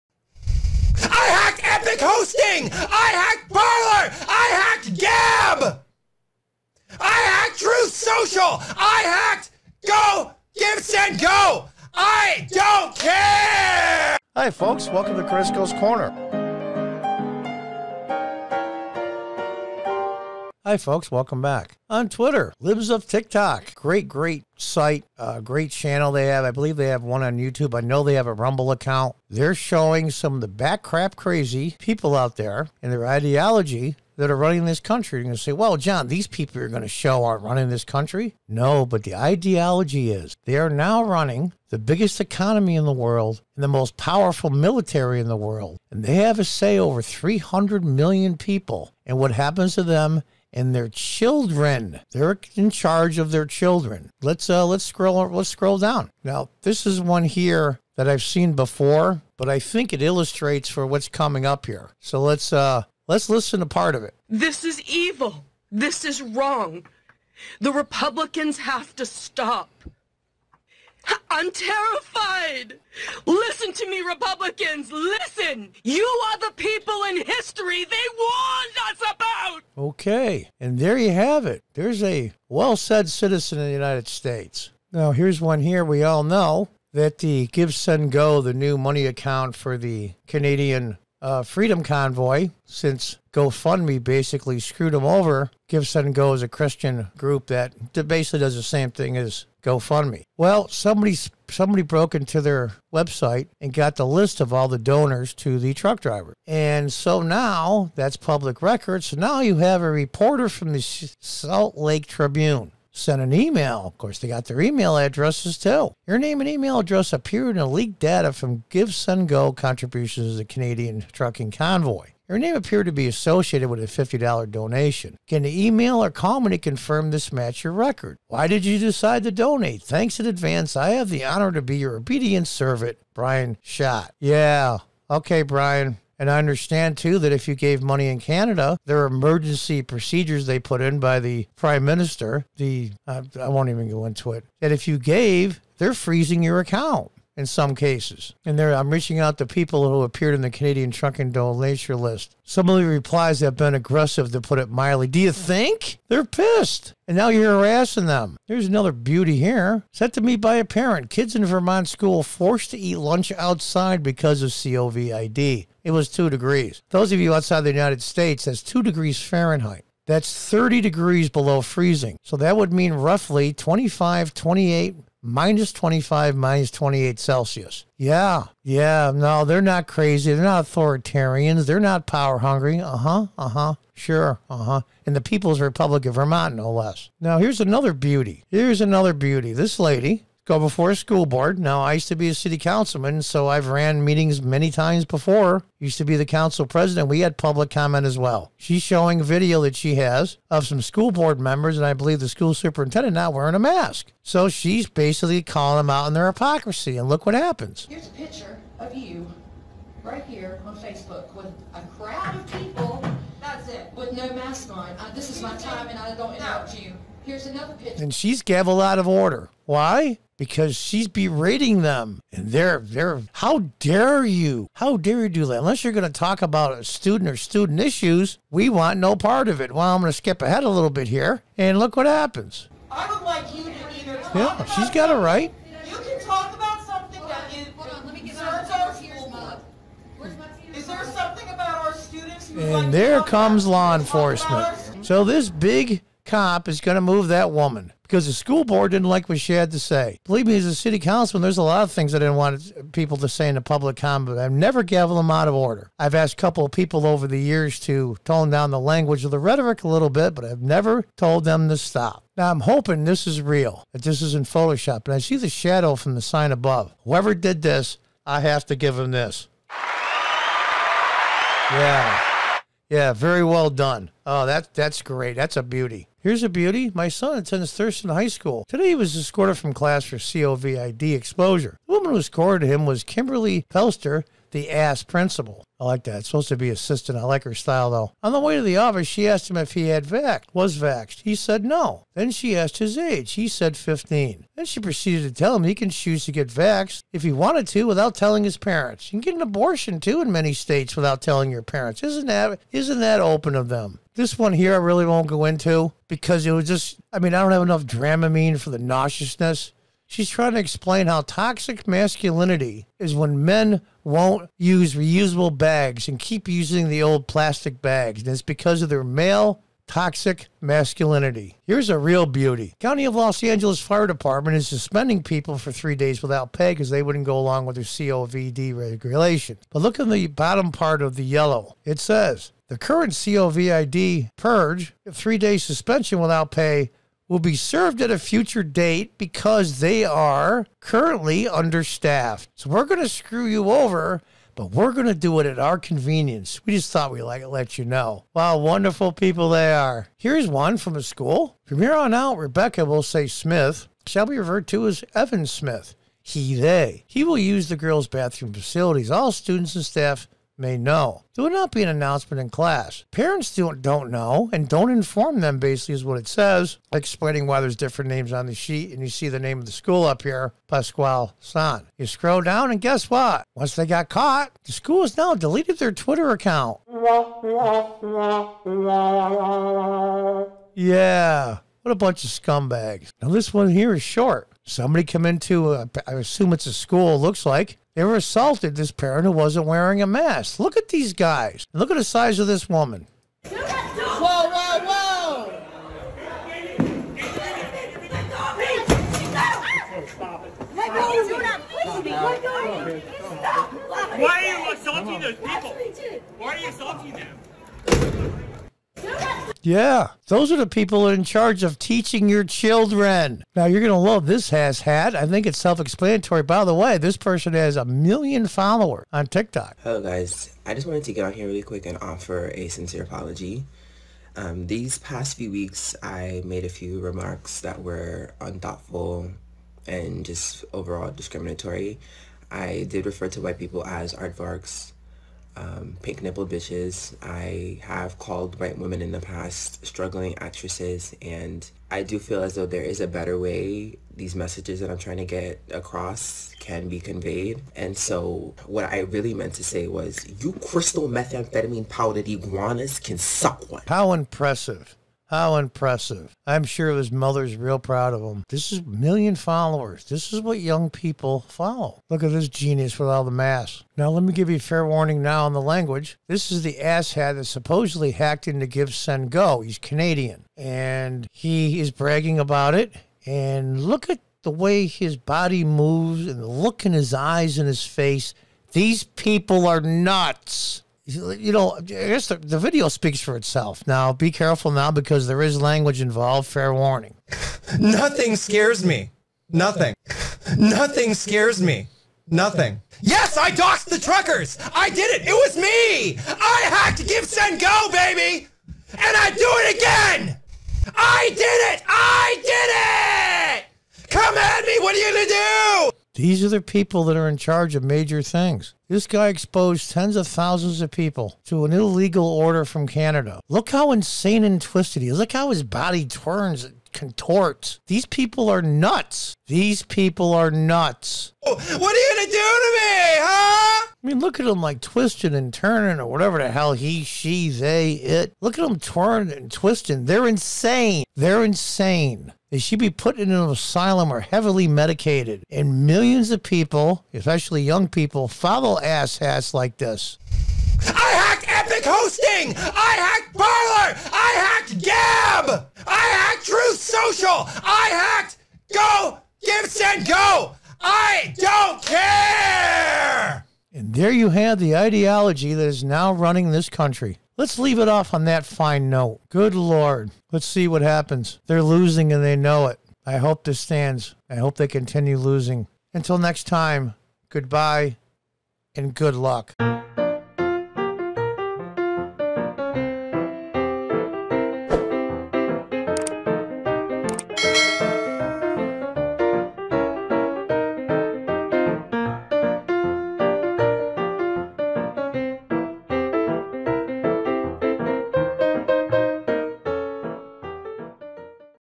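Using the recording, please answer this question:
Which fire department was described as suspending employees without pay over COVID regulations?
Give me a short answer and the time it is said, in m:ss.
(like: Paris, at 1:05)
County of Los Angeles Fire Department, at 5:22.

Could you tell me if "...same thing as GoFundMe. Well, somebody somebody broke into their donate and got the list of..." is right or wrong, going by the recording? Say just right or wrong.
wrong.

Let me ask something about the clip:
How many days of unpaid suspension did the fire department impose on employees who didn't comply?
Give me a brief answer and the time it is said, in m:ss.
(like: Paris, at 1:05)
3, at 5:35.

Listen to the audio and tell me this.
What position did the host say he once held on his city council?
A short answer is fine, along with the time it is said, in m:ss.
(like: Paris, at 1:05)
council president, at 3:16.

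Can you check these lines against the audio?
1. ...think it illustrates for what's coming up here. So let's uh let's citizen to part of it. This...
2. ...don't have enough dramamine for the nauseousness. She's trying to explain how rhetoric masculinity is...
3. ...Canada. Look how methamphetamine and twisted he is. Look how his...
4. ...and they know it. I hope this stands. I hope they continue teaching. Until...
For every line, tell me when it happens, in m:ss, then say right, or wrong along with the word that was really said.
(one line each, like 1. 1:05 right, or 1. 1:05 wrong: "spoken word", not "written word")
1. 0:59 wrong: "listen", not "citizen"
2. 5:07 wrong: "toxic", not "rhetoric"
3. 8:32 wrong: "insane", not "methamphetamine"
4. 9:22 wrong: "losing", not "teaching".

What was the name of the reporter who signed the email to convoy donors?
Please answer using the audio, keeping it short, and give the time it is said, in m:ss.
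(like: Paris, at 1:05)
Brian Schott, at 2:13.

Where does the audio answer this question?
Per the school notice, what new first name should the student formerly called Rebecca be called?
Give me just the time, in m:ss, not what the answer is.
5:55.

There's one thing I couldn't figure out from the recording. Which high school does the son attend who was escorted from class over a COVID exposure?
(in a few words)
Thurston High School.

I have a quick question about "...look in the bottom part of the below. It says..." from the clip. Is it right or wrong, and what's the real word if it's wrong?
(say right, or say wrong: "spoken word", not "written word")
wrong: "yellow", not "below".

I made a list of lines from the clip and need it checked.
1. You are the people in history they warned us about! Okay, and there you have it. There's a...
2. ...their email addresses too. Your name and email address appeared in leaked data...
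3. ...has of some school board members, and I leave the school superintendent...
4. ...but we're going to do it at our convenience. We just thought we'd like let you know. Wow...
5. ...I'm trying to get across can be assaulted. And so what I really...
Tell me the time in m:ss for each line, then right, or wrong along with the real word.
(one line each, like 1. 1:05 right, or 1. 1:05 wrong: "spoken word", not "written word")
1. 1:15 right
2. 1:54 right
3. 3:19 wrong: "believe", not "leave"
4. 5:44 right
5. 7:24 wrong: "conveyed", not "assaulted".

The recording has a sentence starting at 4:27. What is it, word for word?
Whoever did this, I have to give him this.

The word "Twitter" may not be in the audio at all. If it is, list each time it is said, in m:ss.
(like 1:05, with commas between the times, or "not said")
0:22, 6:15.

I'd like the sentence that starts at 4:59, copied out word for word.
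You can get an abortion too in many states without telling your parents.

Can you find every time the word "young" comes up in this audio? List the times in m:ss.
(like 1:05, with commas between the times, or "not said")
7:40, 8:57.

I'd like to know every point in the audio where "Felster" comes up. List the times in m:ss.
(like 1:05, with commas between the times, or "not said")
4:43.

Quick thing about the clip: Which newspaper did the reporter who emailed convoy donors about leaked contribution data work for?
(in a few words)
Salt Lake Tribune.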